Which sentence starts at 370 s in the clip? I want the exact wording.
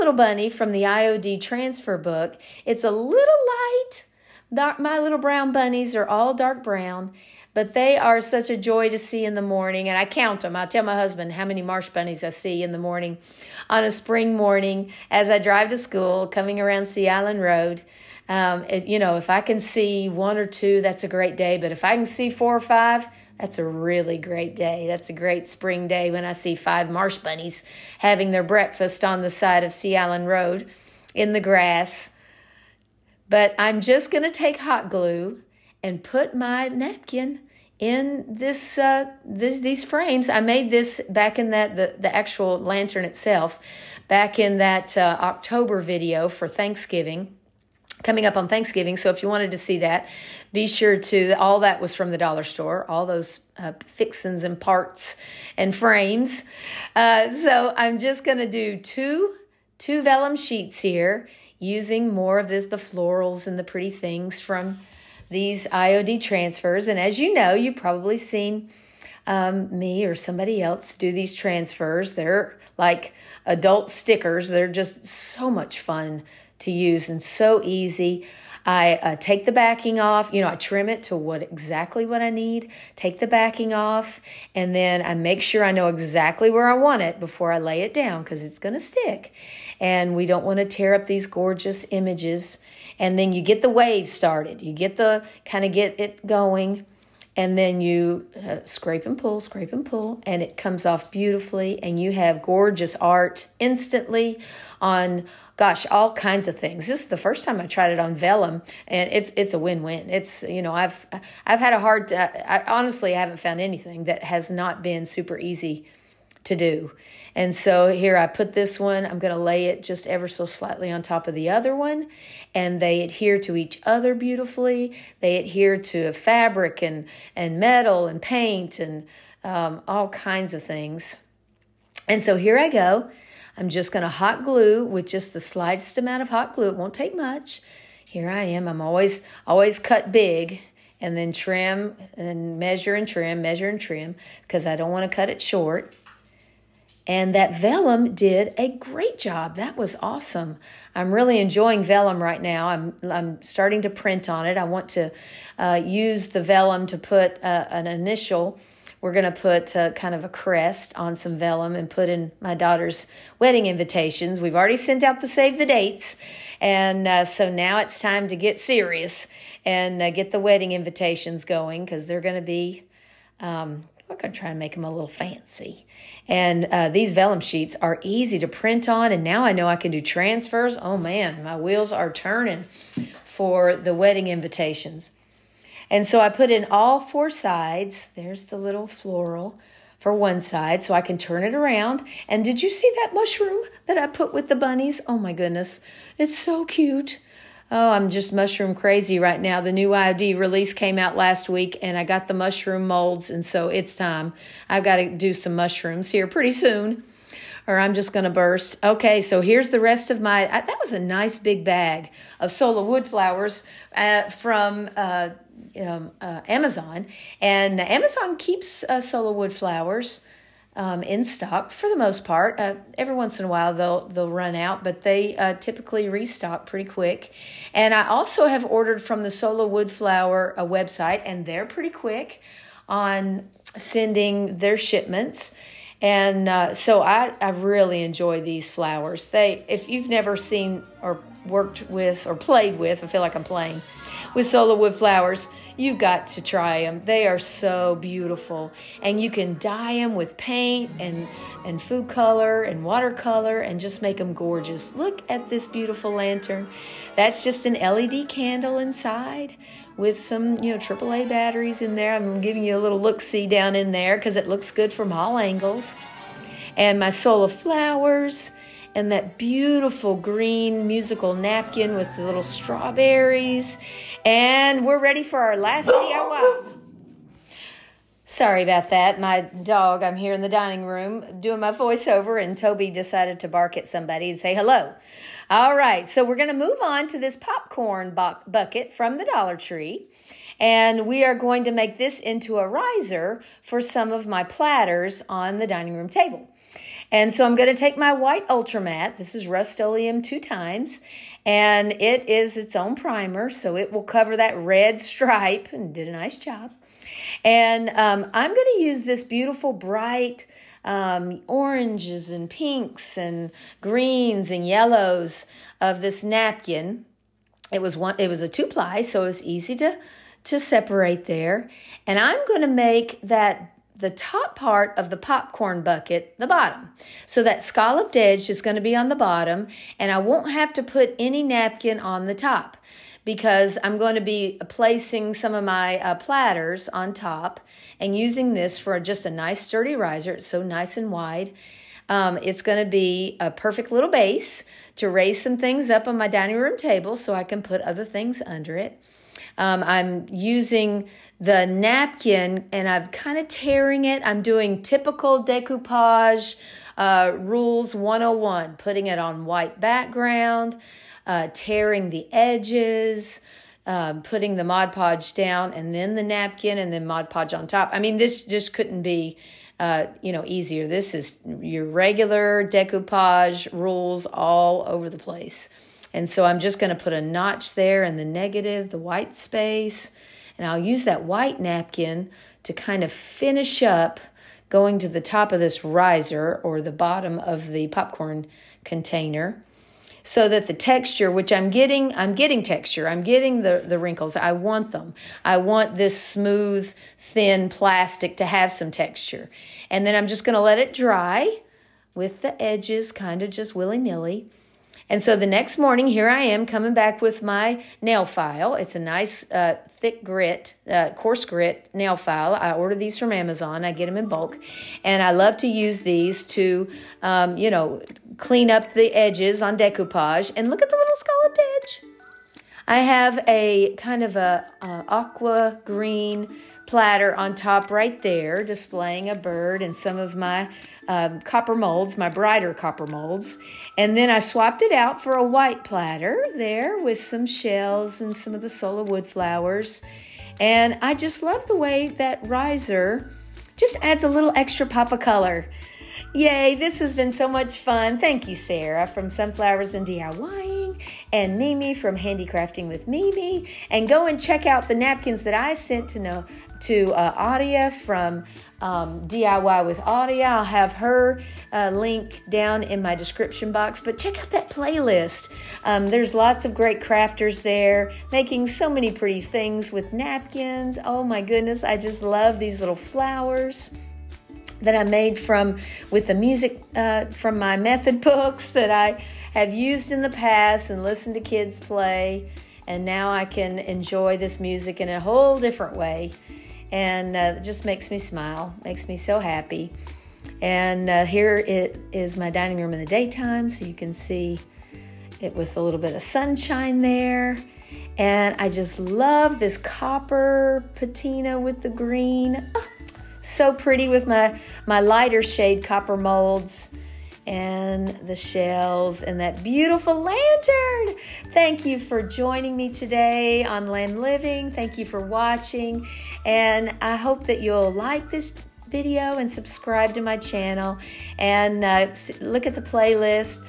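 This is your regular decoupage rules all over the place.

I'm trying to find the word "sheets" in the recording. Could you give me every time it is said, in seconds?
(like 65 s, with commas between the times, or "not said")
60 s, 177 s.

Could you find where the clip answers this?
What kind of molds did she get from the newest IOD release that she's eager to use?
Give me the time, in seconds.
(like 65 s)
202 s.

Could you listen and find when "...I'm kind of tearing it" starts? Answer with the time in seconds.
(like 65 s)
352 s.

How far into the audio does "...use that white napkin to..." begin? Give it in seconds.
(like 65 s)
380 s.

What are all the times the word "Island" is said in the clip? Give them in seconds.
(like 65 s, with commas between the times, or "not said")
17 s, 29 s.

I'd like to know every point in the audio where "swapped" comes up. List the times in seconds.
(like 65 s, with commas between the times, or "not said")
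434 s.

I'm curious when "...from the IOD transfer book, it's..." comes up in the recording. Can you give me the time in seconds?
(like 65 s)
0 s.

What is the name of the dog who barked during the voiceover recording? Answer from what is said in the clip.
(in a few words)
Toby.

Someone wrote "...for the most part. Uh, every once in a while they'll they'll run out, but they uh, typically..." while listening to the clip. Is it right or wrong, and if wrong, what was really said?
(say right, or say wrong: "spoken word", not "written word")
right.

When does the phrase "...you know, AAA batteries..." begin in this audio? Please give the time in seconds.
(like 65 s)
260 s.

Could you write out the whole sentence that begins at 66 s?
And as you know, you've probably seen um, me or somebody else do these transfers.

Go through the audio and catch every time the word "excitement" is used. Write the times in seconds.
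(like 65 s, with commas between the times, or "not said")
not said.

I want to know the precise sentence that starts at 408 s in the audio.
It's a nice uh, thick grit, uh, coarse grit nail file.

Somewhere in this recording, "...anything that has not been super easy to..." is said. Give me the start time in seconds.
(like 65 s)
113 s.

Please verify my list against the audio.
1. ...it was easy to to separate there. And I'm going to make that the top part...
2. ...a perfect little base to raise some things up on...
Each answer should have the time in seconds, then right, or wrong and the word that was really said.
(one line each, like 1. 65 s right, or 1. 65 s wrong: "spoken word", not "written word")
1. 319 s right
2. 343 s right.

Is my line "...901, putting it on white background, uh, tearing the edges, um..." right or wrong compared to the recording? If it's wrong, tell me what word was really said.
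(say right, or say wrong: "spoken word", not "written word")
wrong: "101", not "901".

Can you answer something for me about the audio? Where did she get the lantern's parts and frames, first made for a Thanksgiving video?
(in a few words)
the dollar store.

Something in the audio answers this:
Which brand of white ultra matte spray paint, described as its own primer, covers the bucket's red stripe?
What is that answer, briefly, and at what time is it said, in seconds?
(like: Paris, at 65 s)
Rust-Oleum, at 299 s.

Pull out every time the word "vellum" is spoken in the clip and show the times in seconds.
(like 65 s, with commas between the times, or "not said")
60 s, 108 s, 147 s, 151 s, 156 s, 161 s, 177 s.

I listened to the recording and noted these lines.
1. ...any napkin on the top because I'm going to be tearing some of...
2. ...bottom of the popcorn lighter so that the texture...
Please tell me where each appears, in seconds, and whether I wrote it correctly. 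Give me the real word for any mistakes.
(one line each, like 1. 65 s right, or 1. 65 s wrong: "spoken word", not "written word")
1. 331 s wrong: "placing", not "tearing"
2. 386 s wrong: "container", not "lighter".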